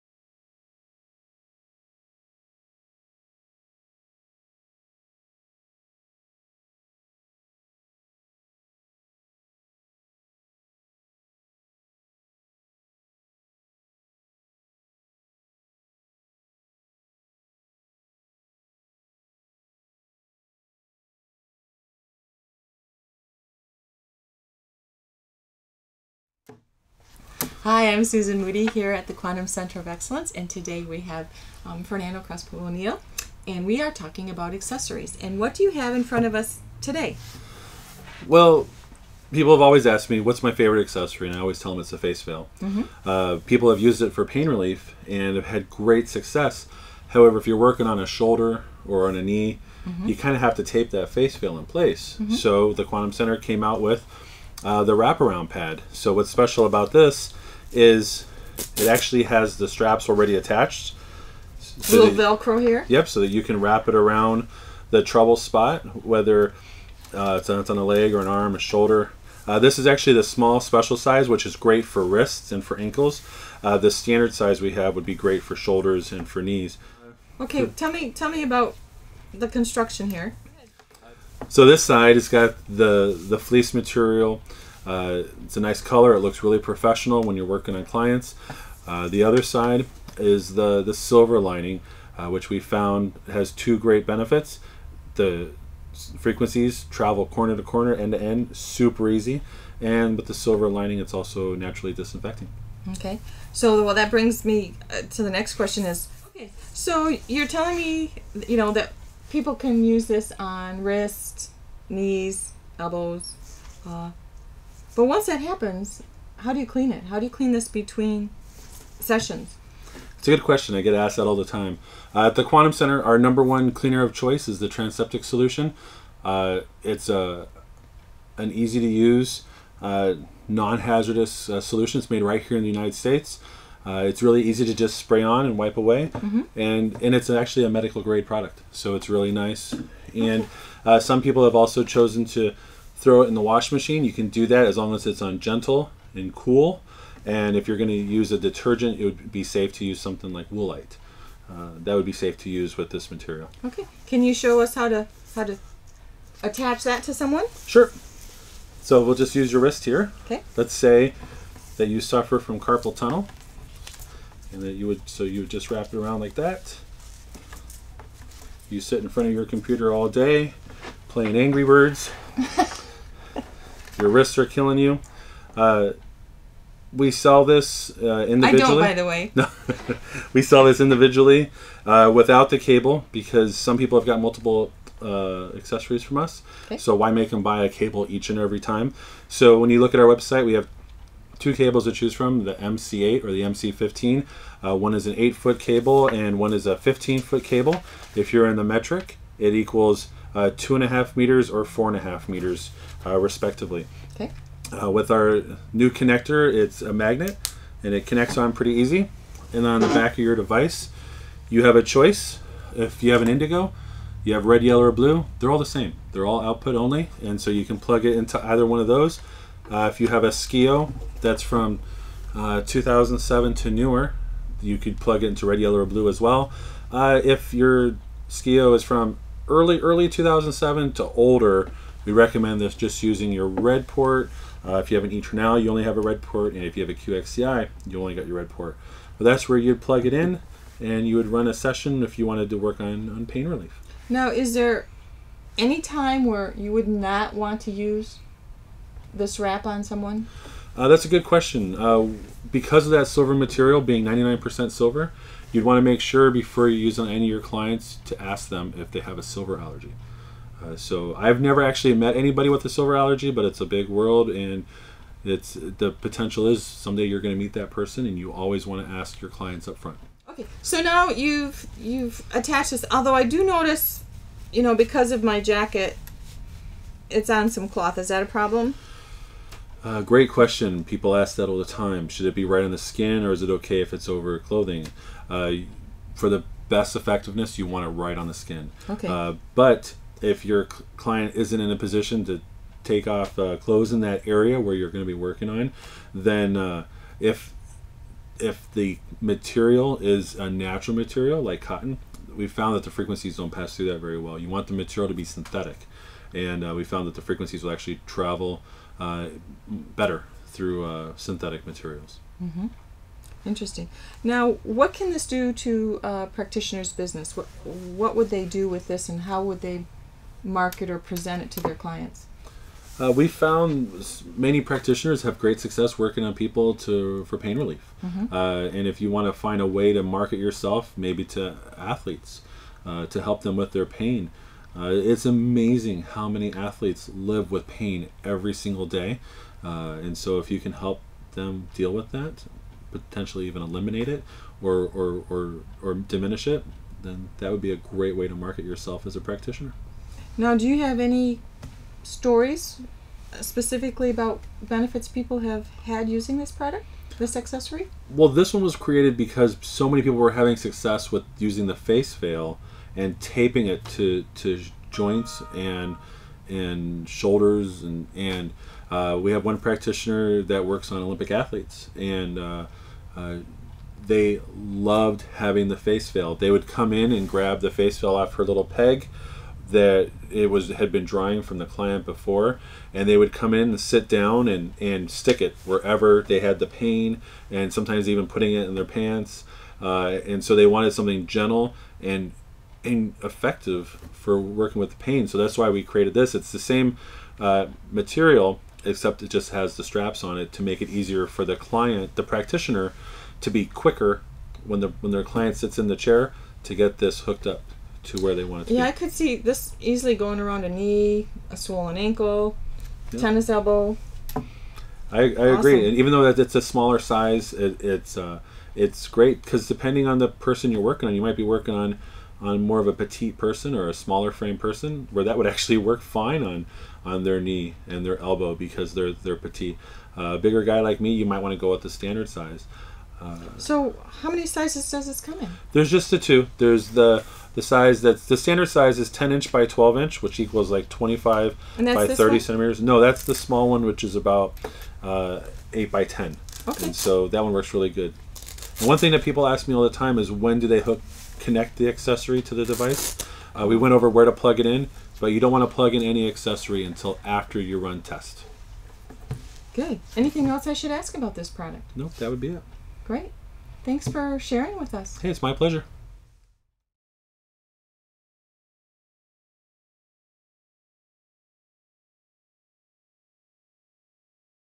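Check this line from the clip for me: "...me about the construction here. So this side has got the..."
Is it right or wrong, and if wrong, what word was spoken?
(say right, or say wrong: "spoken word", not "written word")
right.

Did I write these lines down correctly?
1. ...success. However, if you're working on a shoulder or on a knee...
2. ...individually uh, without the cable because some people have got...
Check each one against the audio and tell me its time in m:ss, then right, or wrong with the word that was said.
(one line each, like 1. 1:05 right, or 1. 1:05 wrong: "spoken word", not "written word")
1. 0:46 right
2. 3:00 right.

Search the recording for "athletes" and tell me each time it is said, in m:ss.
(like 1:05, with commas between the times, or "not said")
5:31, 5:36, 6:11.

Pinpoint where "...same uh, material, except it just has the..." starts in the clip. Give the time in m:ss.
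6:36.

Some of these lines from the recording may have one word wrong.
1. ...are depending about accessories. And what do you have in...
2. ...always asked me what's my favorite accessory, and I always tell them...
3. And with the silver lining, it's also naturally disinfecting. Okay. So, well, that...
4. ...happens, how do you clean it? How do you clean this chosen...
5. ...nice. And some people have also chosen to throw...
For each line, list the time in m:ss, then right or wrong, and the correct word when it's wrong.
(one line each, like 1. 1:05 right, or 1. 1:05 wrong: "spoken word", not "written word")
1. 0:33 wrong: "talking", not "depending"
2. 0:39 right
3. 1:39 right
4. 1:55 wrong: "between", not "chosen"
5. 2:19 right.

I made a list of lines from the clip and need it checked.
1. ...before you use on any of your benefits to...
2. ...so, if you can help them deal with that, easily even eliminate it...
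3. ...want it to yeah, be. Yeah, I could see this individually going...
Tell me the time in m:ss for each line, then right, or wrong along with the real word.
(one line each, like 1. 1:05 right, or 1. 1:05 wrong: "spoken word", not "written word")
1. 4:16 wrong: "clients", not "benefits"
2. 5:40 wrong: "potentially", not "easily"
3. 6:48 wrong: "easily", not "individually".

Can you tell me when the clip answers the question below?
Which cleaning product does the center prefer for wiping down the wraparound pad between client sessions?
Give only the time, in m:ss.
2:04.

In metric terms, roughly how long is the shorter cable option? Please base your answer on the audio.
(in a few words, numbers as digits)
2.5 meters.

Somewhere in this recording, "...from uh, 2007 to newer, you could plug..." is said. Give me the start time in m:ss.
3:41.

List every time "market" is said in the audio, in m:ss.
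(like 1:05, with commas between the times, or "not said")
5:20, 5:30, 5:48.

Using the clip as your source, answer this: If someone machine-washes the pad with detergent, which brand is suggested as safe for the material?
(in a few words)
Woolite.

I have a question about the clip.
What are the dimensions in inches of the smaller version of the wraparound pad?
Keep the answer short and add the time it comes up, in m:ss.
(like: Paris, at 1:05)
8 by 10, at 7:25.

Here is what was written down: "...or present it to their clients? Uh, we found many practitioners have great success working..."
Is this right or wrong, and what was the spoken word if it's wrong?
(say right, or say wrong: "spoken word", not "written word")
right.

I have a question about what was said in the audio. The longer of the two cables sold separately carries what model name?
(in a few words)
MC15.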